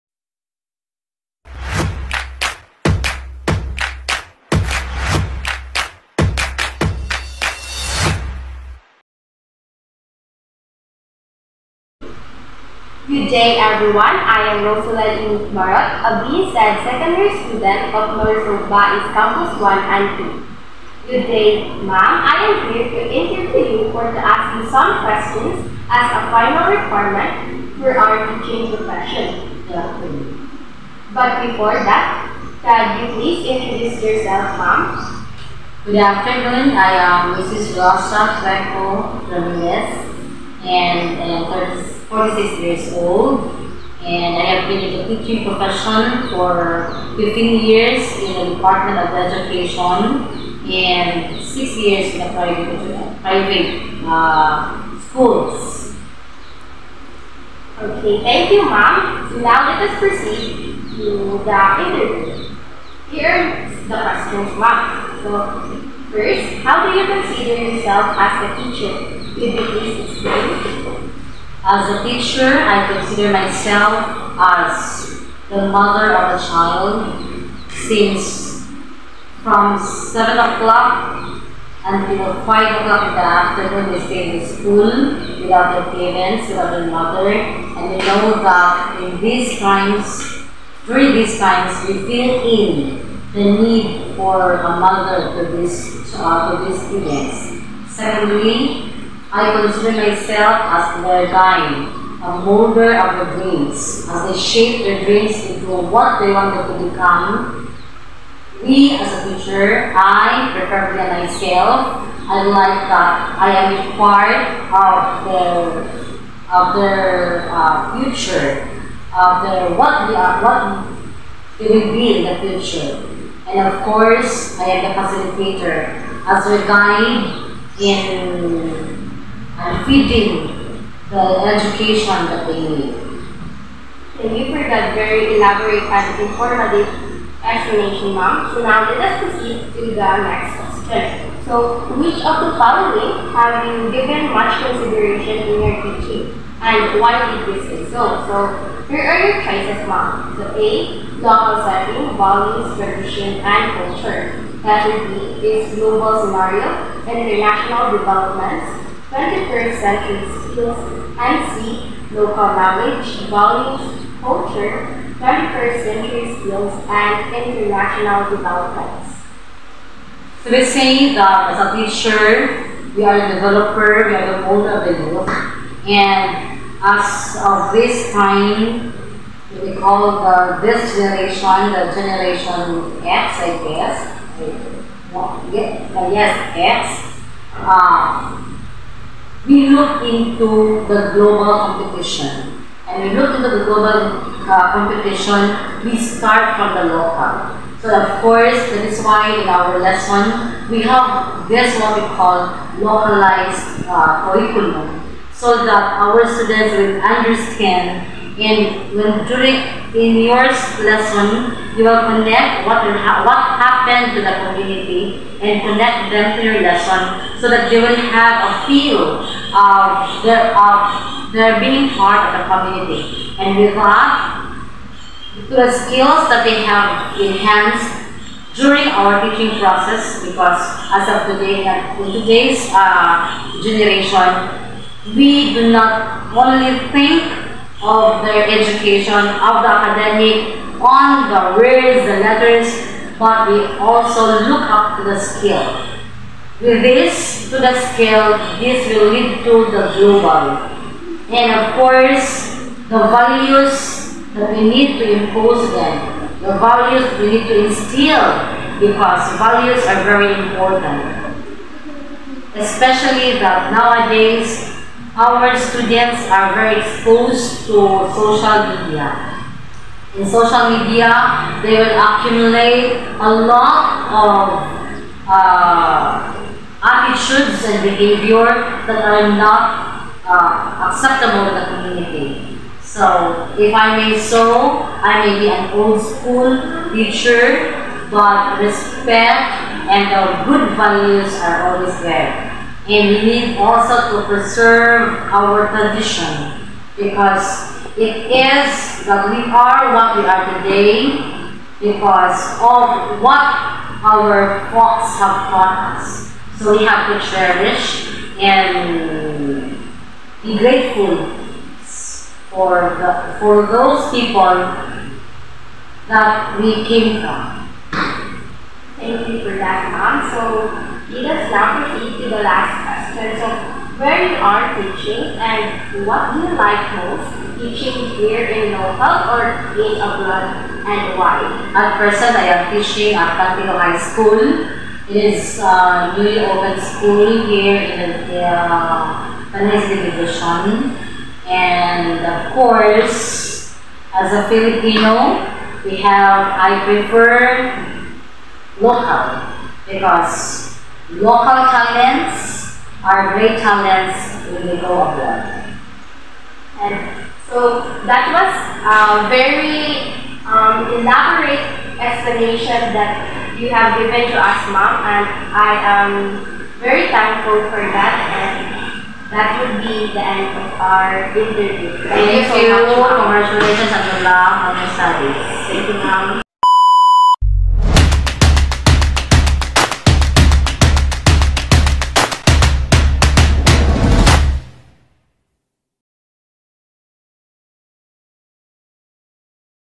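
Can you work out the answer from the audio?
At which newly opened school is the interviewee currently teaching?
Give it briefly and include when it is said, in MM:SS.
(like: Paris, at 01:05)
Cantino High School, at 05:33.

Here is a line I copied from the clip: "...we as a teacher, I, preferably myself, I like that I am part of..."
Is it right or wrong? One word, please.
right.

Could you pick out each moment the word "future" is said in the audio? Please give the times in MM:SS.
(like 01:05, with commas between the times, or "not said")
01:58, 02:02.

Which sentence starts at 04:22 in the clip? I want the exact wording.
Especially that nowadays, our students are very exposed to social media.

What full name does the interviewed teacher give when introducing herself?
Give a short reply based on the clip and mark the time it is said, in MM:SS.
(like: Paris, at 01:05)
Rosa Franco Ramirez, at 00:37.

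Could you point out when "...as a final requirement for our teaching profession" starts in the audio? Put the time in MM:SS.
00:25.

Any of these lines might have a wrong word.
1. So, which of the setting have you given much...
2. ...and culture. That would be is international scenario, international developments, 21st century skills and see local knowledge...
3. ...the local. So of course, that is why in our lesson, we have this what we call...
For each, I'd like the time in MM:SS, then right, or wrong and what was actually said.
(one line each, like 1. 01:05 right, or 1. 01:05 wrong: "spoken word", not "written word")
1. 02:21 wrong: "following", not "setting"
2. 02:33 wrong: "global", not "international"
3. 03:16 right.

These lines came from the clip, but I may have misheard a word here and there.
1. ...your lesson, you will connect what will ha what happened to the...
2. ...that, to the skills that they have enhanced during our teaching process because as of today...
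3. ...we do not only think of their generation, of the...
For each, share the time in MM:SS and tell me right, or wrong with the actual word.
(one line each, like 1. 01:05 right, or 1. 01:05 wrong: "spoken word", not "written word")
1. 03:30 right
2. 03:43 right
3. 03:55 wrong: "education", not "generation".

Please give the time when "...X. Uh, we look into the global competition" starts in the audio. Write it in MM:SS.
03:06.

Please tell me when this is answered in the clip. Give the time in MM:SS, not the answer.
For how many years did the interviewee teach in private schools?
00:51.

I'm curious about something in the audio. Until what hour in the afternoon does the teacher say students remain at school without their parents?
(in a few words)
5 o'clock.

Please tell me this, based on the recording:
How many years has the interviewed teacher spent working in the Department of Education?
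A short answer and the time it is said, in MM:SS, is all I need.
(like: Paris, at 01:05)
15 years, at 00:47.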